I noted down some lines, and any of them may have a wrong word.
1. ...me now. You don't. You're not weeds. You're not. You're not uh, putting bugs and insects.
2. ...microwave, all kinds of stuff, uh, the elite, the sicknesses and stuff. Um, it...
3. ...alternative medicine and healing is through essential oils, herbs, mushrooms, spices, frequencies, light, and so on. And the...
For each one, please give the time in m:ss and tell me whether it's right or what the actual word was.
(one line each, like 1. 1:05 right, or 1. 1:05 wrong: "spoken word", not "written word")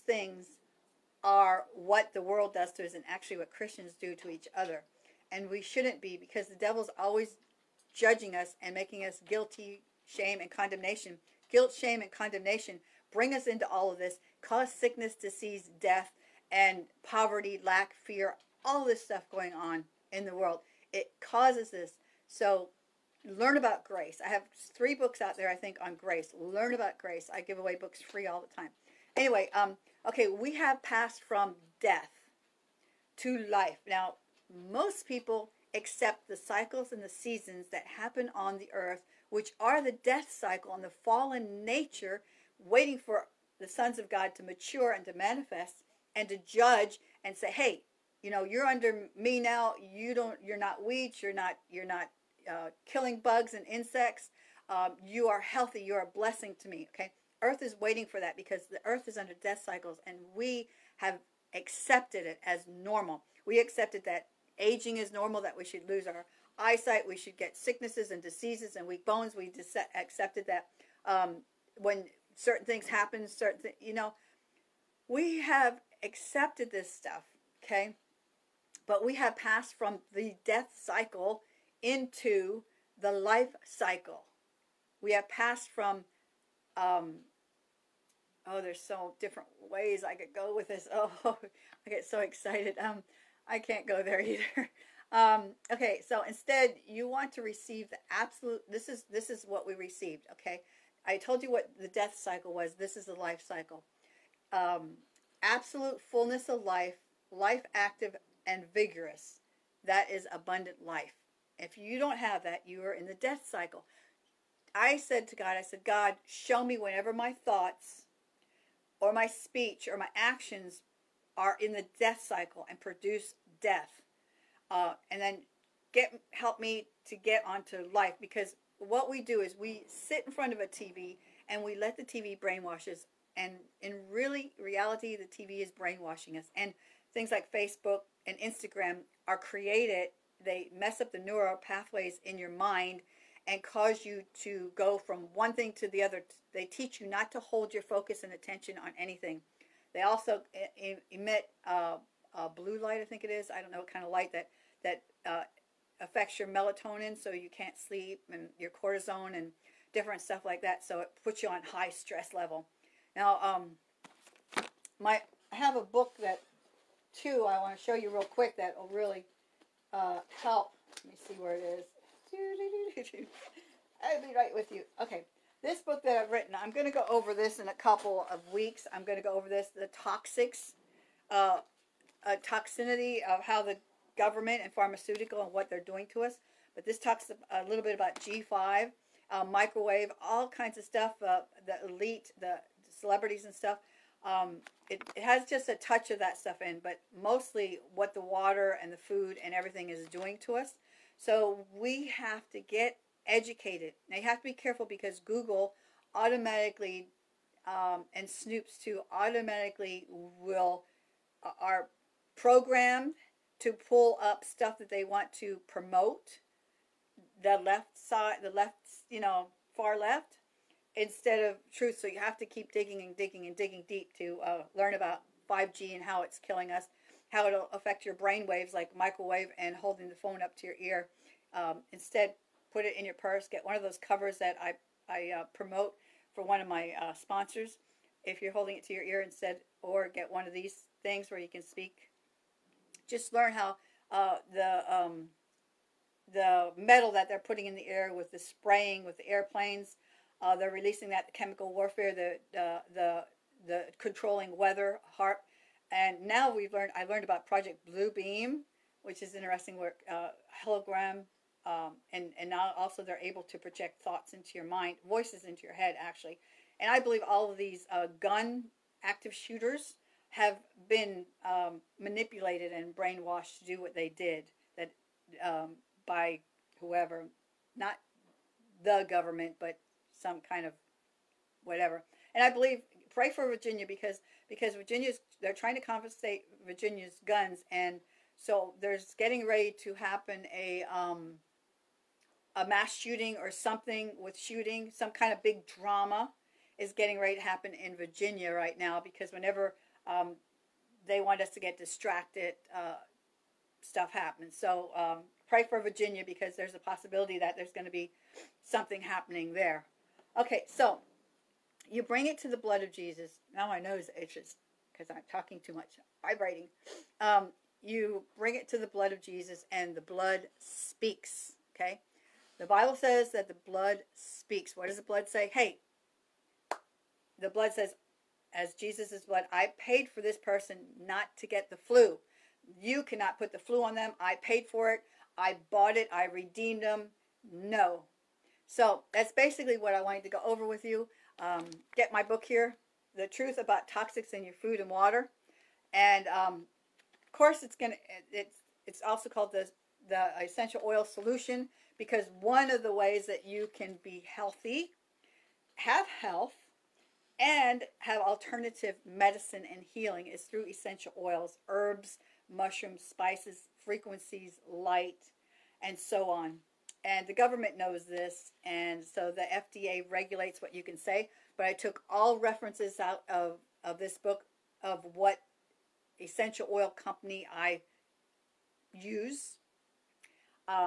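1. 0:49 wrong: "killing", not "putting"
2. 3:09 wrong: "celebrities", not "sicknesses"
3. 5:58 right.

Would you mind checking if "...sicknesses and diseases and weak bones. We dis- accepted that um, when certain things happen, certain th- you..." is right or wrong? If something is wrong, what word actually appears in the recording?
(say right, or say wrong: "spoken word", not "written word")
right.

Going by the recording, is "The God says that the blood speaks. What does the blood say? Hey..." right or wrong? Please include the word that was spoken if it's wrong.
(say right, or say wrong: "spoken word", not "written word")
wrong: "Bible", not "God".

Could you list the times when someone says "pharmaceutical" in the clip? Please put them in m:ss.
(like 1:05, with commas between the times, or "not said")
3:04.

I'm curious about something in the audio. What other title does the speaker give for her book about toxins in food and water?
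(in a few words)
Essential Oil Solution.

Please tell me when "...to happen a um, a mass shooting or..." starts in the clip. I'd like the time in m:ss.
4:49.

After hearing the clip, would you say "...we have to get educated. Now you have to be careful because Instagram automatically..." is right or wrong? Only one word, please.
wrong.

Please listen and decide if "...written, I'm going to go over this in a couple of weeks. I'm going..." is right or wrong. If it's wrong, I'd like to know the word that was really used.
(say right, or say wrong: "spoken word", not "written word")
right.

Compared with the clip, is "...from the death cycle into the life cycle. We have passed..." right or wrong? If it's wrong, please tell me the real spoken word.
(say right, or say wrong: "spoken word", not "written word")
right.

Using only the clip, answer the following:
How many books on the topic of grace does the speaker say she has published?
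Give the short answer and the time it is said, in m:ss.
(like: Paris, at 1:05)
3, at 0:24.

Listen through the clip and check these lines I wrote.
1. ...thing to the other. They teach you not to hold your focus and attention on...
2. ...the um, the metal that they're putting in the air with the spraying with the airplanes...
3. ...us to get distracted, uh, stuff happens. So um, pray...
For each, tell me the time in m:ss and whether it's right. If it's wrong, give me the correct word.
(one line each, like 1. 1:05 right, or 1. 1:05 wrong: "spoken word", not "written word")
1. 2:25 right
2. 4:04 right
3. 5:01 right.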